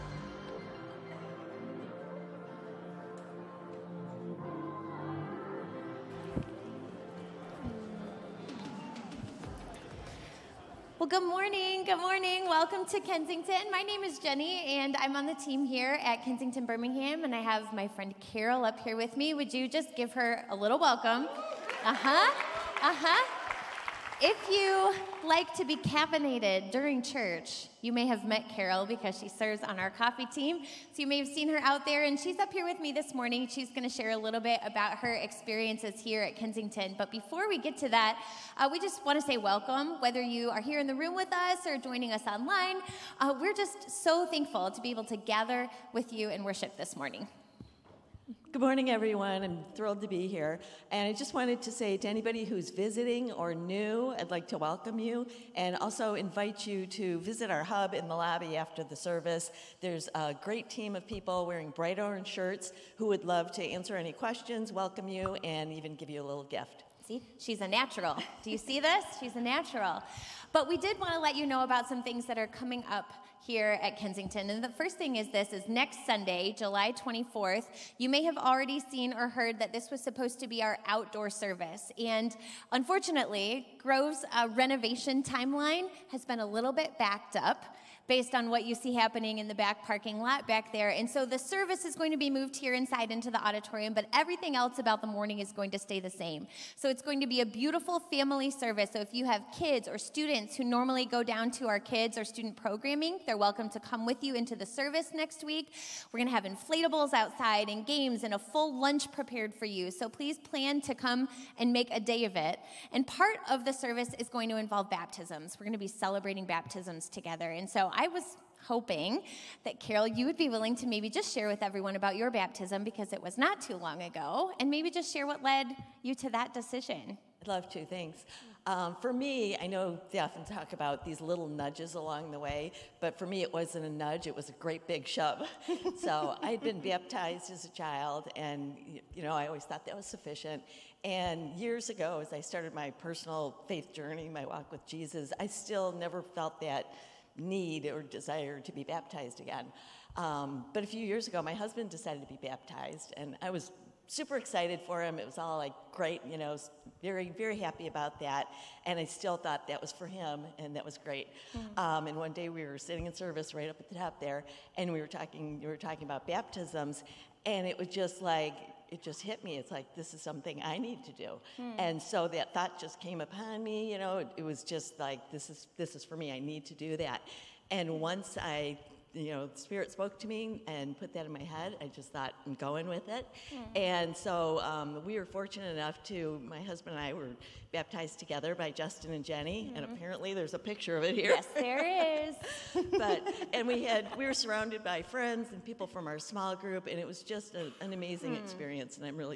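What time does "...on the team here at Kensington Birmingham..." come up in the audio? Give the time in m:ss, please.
0:15.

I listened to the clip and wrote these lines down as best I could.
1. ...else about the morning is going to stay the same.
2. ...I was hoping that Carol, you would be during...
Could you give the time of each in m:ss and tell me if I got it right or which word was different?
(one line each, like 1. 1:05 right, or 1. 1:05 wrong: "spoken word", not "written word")
1. 1:34 right
2. 1:57 wrong: "willing", not "during".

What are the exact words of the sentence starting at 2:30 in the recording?
Um, but a few years ago, my husband decided to be baptized, and I was super excited for him.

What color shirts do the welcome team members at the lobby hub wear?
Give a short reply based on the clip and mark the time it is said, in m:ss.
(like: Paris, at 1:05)
Bright orange, at 1:01.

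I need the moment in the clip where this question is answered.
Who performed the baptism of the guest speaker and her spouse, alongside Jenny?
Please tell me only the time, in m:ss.
3:08.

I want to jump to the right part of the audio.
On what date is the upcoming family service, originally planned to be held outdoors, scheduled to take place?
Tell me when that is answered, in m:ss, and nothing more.
1:16.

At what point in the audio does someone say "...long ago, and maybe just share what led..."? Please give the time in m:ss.
2:03.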